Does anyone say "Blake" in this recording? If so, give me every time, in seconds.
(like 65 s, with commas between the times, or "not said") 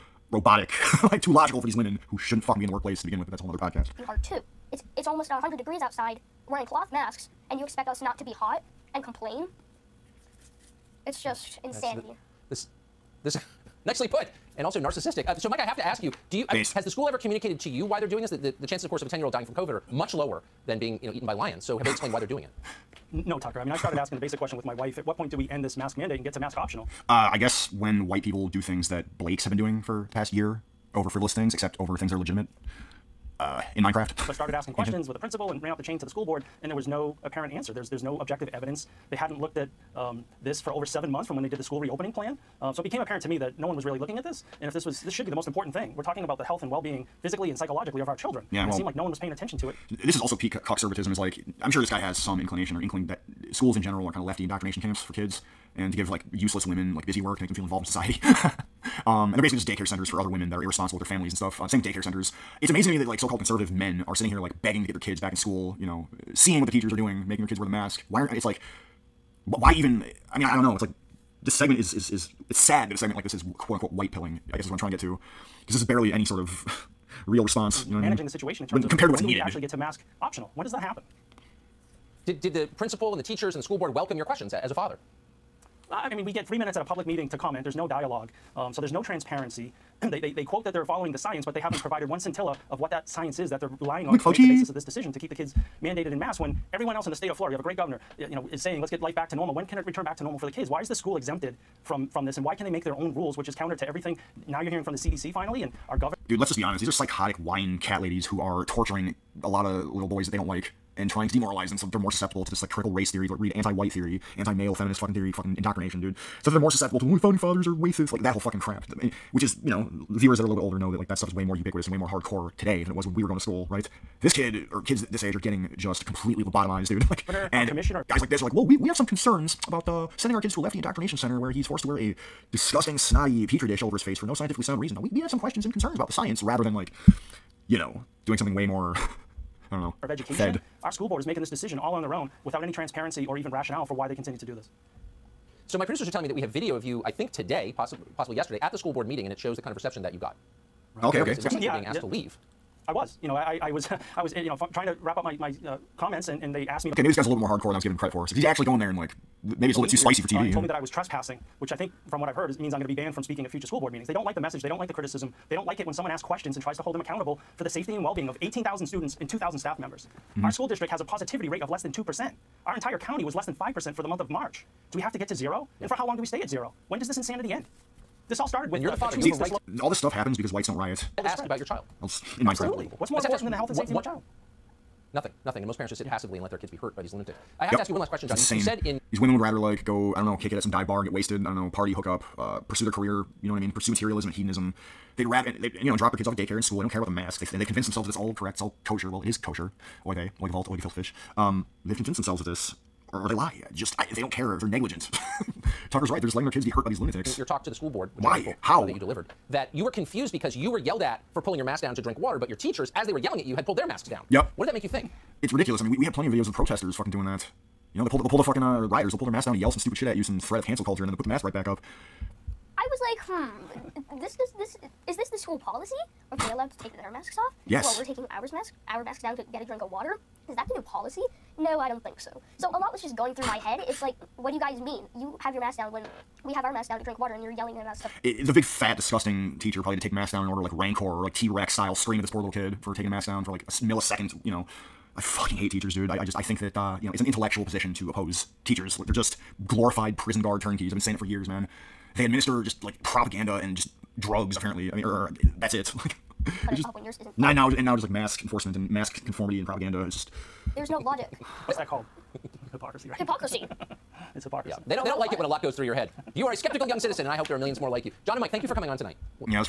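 29 s.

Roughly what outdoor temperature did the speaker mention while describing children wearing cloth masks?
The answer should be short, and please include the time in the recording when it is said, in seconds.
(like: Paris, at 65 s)
almost 100 degrees, at 5 s.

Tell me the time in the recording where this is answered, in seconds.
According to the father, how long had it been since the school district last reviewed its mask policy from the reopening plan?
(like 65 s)
40 s.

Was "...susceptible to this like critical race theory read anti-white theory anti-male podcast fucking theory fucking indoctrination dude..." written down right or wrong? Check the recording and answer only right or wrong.
wrong.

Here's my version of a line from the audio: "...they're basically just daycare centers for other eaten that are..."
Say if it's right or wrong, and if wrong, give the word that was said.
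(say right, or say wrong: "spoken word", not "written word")
wrong: "women", not "eaten".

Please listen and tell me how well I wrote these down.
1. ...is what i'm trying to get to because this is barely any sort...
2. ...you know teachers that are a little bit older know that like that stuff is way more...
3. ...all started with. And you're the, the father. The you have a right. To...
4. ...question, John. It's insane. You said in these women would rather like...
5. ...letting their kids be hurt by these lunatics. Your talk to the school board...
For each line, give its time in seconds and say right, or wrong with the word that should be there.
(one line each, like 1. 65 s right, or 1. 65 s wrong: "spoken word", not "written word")
1. 74 s right
2. 119 s wrong: "viewers", not "teachers"
3. 178 s right
4. 188 s right
5. 206 s right.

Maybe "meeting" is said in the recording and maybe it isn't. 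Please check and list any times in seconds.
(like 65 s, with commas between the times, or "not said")
87 s, 149 s, 163 s.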